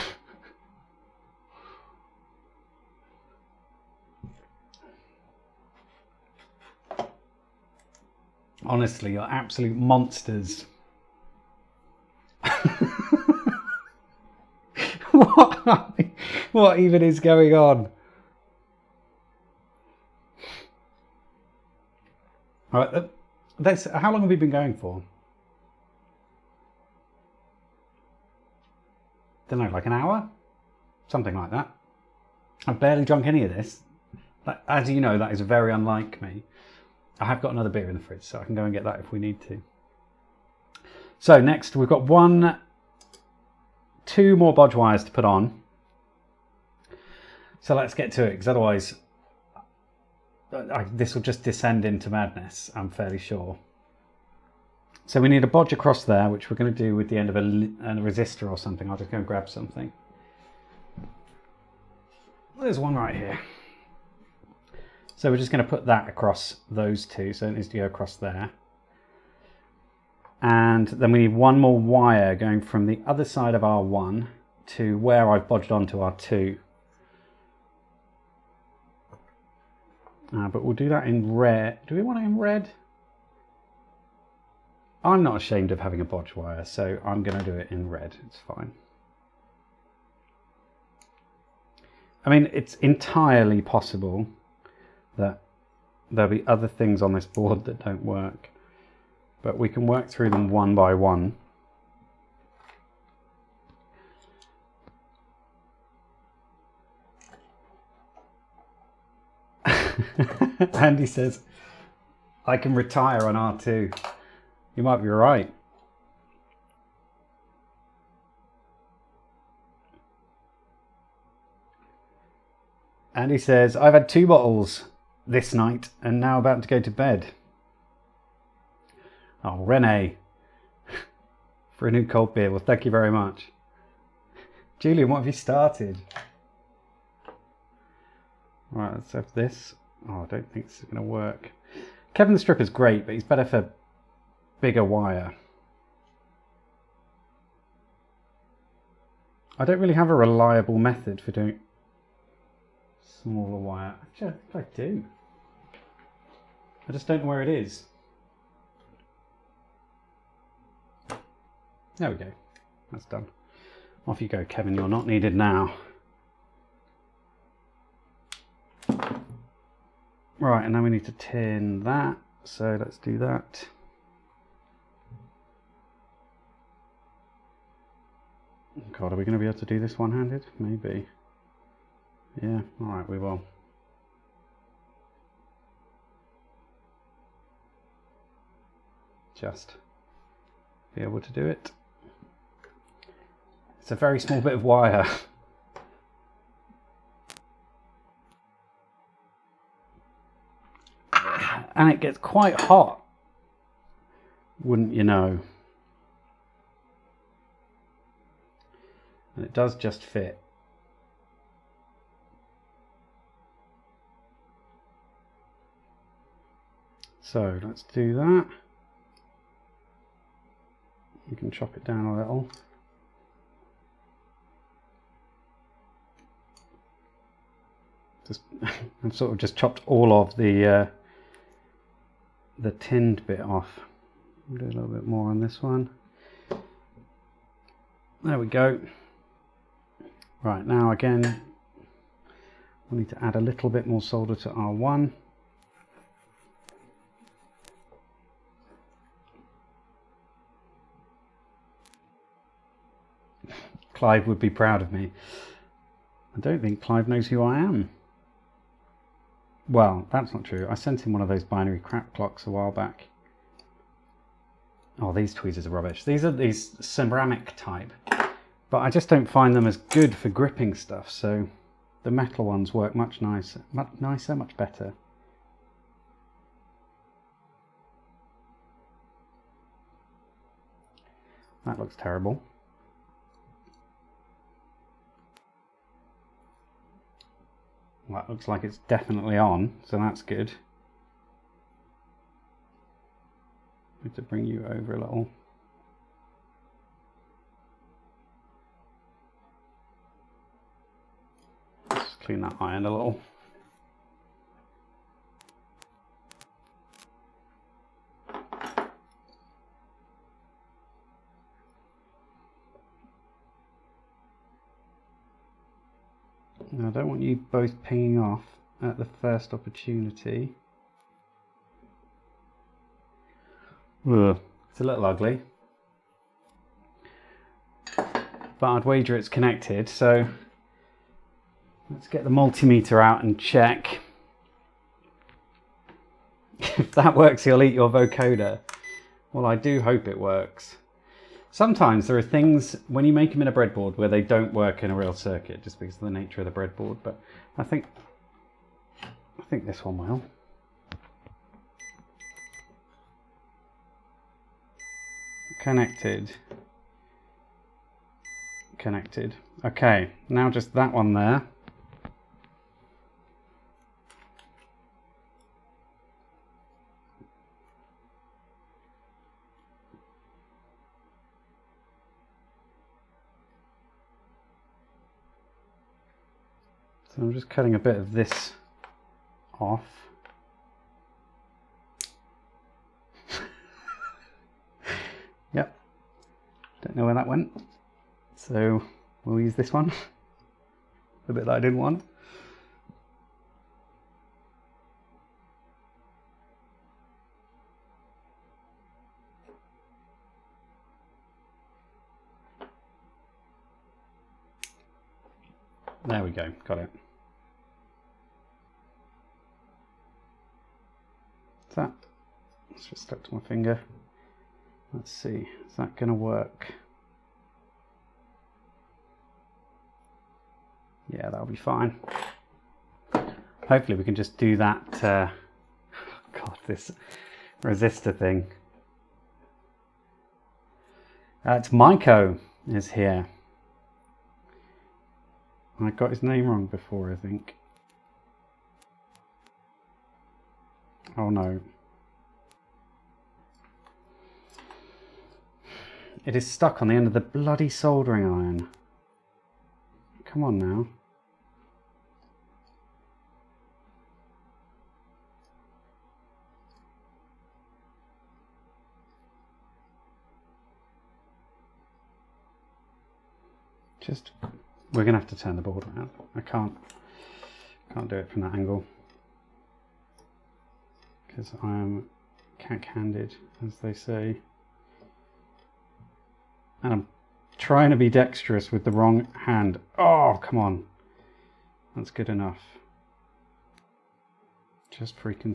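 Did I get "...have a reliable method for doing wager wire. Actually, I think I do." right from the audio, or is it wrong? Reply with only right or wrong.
wrong.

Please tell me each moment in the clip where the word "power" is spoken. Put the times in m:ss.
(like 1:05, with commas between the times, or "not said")
not said.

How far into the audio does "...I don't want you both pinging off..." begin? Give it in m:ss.
5:16.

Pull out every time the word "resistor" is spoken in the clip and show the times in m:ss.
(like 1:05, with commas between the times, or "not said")
0:57, 7:07.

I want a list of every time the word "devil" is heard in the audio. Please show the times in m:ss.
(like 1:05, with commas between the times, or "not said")
not said.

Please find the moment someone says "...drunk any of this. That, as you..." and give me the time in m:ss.
0:33.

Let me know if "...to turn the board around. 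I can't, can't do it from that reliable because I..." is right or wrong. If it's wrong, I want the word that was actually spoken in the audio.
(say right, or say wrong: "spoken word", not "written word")
wrong: "angle", not "reliable".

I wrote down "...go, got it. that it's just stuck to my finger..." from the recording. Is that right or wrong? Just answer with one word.
right.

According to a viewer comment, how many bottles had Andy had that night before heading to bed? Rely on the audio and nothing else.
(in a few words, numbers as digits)
2.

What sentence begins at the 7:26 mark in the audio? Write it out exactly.
It is stuck on the end of the bloody soldering iron.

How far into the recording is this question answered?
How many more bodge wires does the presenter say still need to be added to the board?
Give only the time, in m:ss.
0:44.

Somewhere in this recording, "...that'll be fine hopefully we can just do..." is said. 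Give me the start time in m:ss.
7:01.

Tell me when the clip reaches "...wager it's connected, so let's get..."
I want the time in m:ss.
5:28.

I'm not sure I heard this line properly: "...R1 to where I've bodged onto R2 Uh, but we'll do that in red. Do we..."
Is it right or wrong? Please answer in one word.
right.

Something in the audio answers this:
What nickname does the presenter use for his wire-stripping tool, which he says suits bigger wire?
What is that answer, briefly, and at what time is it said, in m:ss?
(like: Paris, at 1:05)
Kevin the Stripper, at 2:22.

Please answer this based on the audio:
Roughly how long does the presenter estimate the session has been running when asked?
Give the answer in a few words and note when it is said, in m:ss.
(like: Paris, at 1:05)
an hour, at 0:29.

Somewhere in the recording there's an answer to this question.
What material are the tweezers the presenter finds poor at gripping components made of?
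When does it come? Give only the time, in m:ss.
4:26.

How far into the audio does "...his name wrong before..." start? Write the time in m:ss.
7:16.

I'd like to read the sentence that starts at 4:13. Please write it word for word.
Clive would be proud of me.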